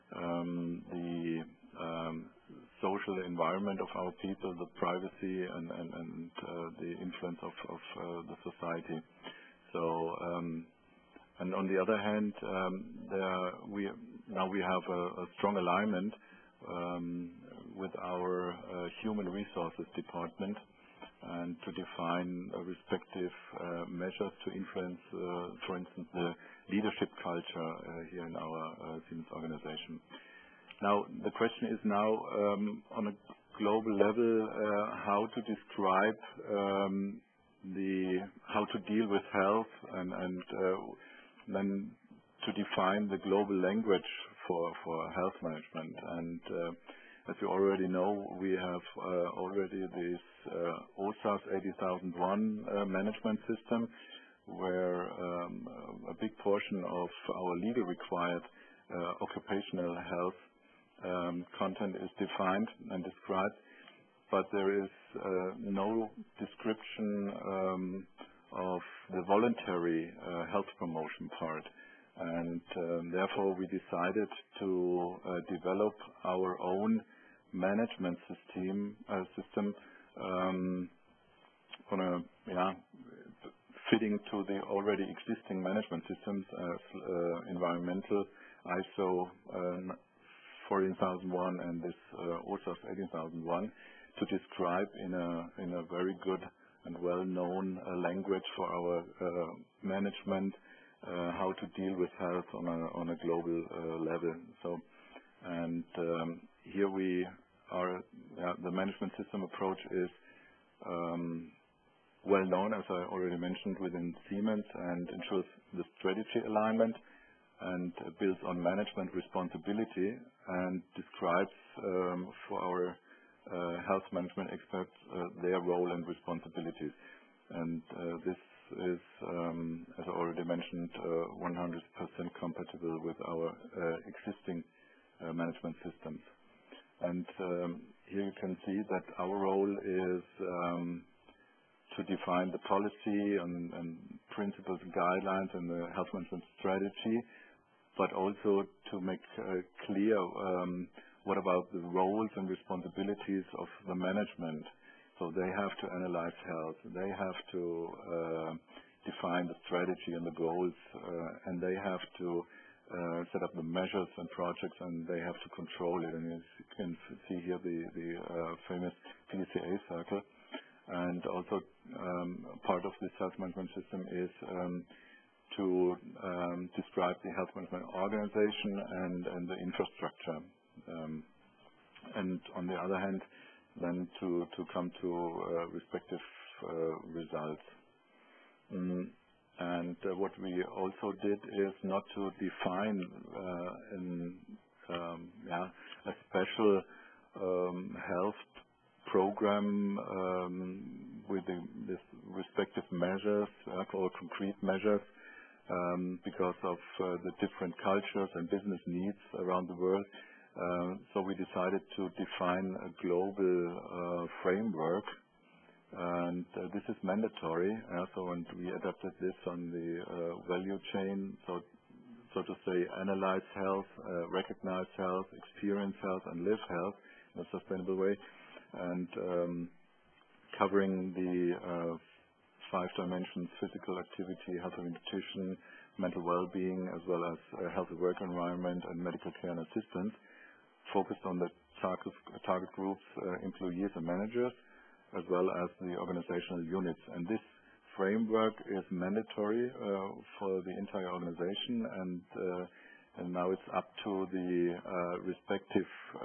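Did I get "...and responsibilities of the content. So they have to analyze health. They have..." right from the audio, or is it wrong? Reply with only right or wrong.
wrong.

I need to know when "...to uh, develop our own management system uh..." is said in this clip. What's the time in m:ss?
1:14.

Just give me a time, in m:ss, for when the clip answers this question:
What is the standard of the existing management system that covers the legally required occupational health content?
0:51.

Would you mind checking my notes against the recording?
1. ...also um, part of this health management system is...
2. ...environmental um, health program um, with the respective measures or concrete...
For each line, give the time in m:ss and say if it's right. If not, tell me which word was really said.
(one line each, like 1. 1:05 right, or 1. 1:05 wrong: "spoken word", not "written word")
1. 2:51 right
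2. 3:16 wrong: "special", not "environmental".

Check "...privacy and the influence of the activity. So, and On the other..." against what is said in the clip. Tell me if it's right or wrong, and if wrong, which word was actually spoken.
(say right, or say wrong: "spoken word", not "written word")
wrong: "society", not "activity".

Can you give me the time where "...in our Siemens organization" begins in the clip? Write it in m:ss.
0:28.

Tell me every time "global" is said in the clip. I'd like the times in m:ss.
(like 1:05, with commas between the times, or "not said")
0:33, 0:43, 1:43, 3:33.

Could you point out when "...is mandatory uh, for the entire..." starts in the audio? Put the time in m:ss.
4:08.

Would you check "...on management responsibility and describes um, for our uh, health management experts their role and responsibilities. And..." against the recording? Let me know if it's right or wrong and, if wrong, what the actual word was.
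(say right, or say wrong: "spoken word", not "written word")
right.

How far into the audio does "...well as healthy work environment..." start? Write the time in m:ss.
3:57.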